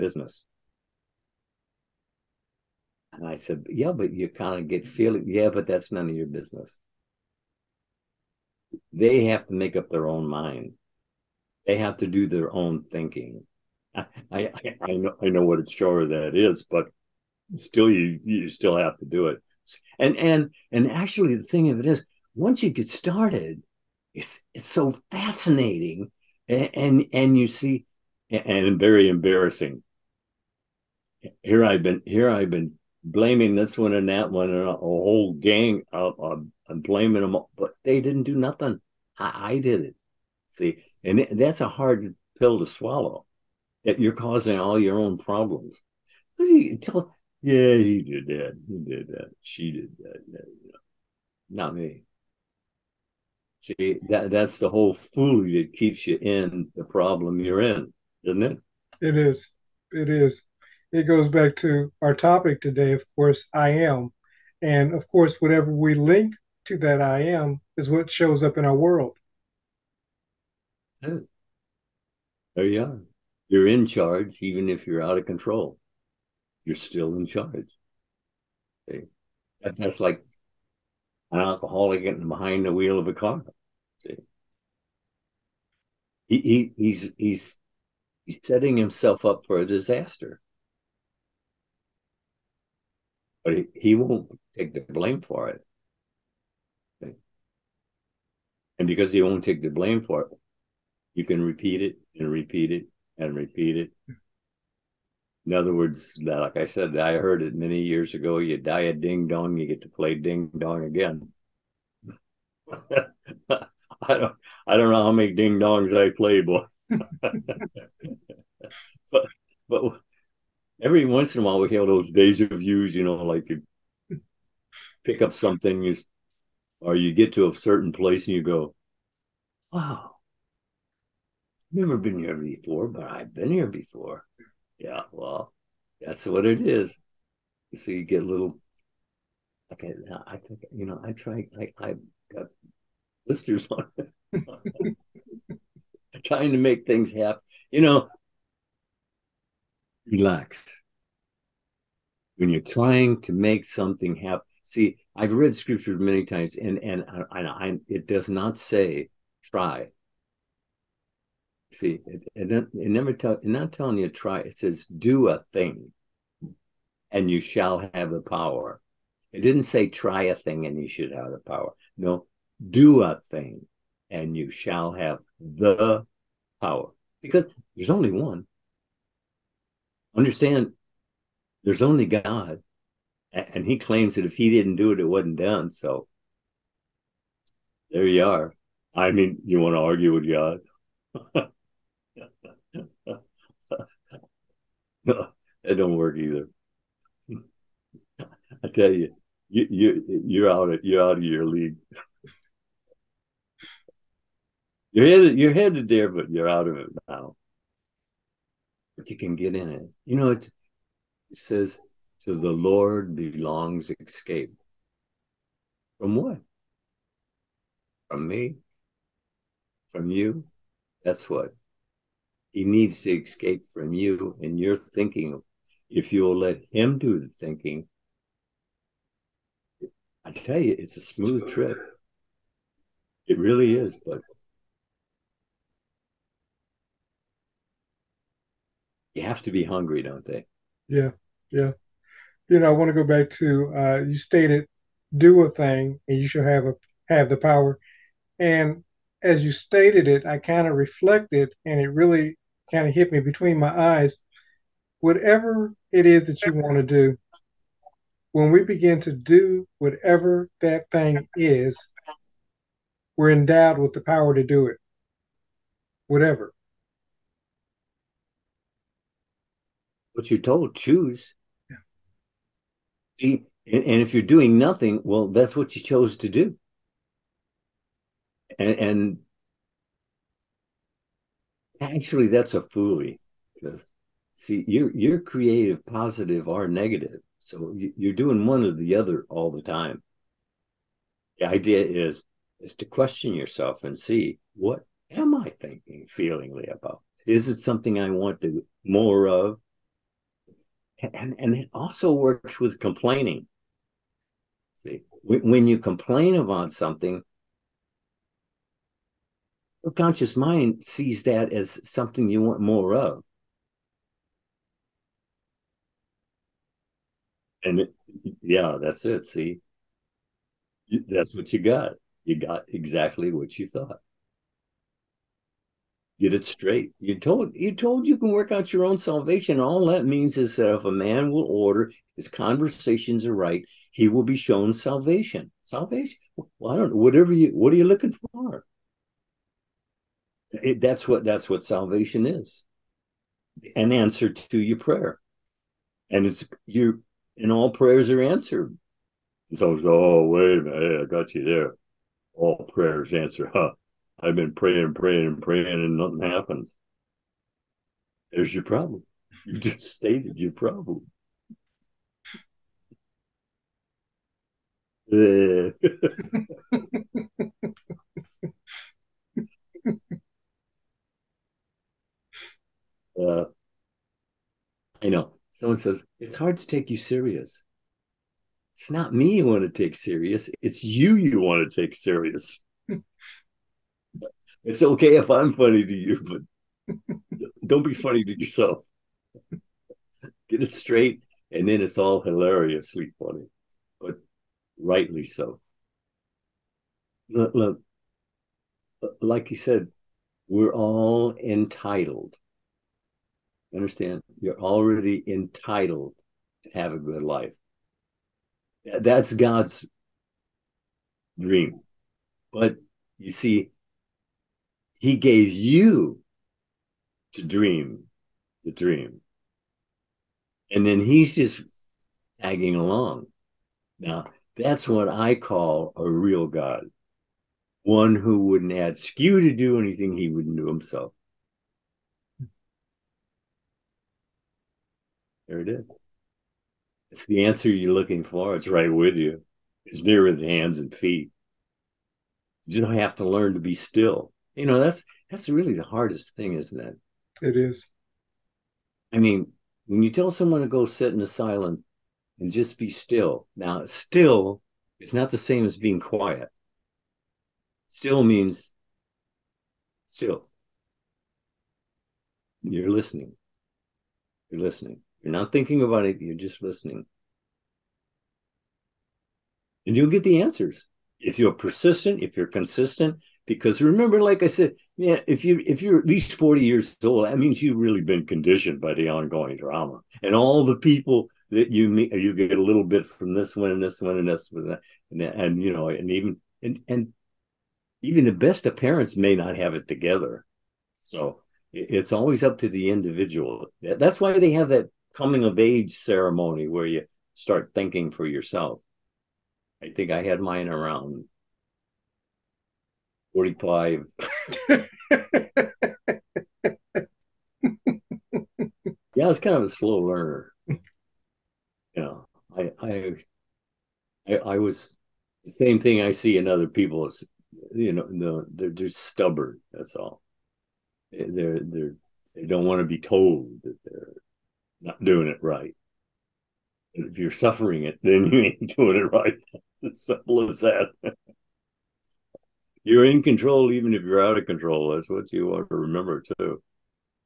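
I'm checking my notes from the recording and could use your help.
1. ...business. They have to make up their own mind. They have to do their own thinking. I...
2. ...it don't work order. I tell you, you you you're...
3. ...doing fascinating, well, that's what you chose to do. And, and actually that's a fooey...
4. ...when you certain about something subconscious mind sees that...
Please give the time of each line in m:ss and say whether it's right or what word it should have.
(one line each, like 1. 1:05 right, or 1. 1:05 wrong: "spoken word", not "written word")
1. 0:06 right
2. 3:15 wrong: "either", not "order"
3. 4:34 wrong: "nothing", not "fascinating"
4. 5:05 wrong: "complain", not "certain".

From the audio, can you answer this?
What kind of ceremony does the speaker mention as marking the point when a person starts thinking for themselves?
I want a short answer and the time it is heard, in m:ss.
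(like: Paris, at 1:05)
Coming of age ceremony, at 8:15.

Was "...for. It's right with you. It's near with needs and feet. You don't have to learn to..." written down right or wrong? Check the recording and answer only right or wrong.
wrong.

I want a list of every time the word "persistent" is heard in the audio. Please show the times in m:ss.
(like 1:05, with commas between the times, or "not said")
7:51.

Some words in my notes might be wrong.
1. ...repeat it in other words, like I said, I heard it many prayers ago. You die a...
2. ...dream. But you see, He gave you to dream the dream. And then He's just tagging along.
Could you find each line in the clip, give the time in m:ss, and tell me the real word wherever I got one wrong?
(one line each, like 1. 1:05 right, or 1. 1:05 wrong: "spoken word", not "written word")
1. 1:43 wrong: "years", not "prayers"
2. 6:51 right.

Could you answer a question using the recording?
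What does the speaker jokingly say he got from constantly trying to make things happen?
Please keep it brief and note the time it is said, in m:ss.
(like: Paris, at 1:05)
Blisters, at 2:23.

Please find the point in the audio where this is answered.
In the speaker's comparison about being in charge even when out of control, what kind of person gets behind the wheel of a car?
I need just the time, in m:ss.
1:21.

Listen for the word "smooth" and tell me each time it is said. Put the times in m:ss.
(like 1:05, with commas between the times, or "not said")
3:51.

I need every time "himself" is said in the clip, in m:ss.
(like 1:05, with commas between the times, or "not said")
1:28, 7:10.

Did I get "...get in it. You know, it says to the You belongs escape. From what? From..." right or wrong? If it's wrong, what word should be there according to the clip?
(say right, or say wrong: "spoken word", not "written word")
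wrong: "Lord", not "You".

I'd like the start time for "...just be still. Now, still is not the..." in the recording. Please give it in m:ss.
7:32.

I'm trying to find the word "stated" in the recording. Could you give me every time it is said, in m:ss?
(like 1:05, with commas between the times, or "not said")
4:04, 4:09, 5:59.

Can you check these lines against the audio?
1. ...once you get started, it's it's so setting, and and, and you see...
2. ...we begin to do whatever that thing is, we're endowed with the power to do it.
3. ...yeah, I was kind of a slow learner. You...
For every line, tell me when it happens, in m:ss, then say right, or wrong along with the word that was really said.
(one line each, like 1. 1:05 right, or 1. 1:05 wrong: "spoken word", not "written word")
1. 0:22 wrong: "fascinating", not "setting"
2. 4:18 right
3. 8:24 right.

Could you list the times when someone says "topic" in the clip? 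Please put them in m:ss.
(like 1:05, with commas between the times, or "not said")
1:02.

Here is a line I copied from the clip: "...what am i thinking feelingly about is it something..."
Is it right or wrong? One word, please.
right.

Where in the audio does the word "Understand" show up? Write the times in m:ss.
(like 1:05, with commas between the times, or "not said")
3:00, 6:43.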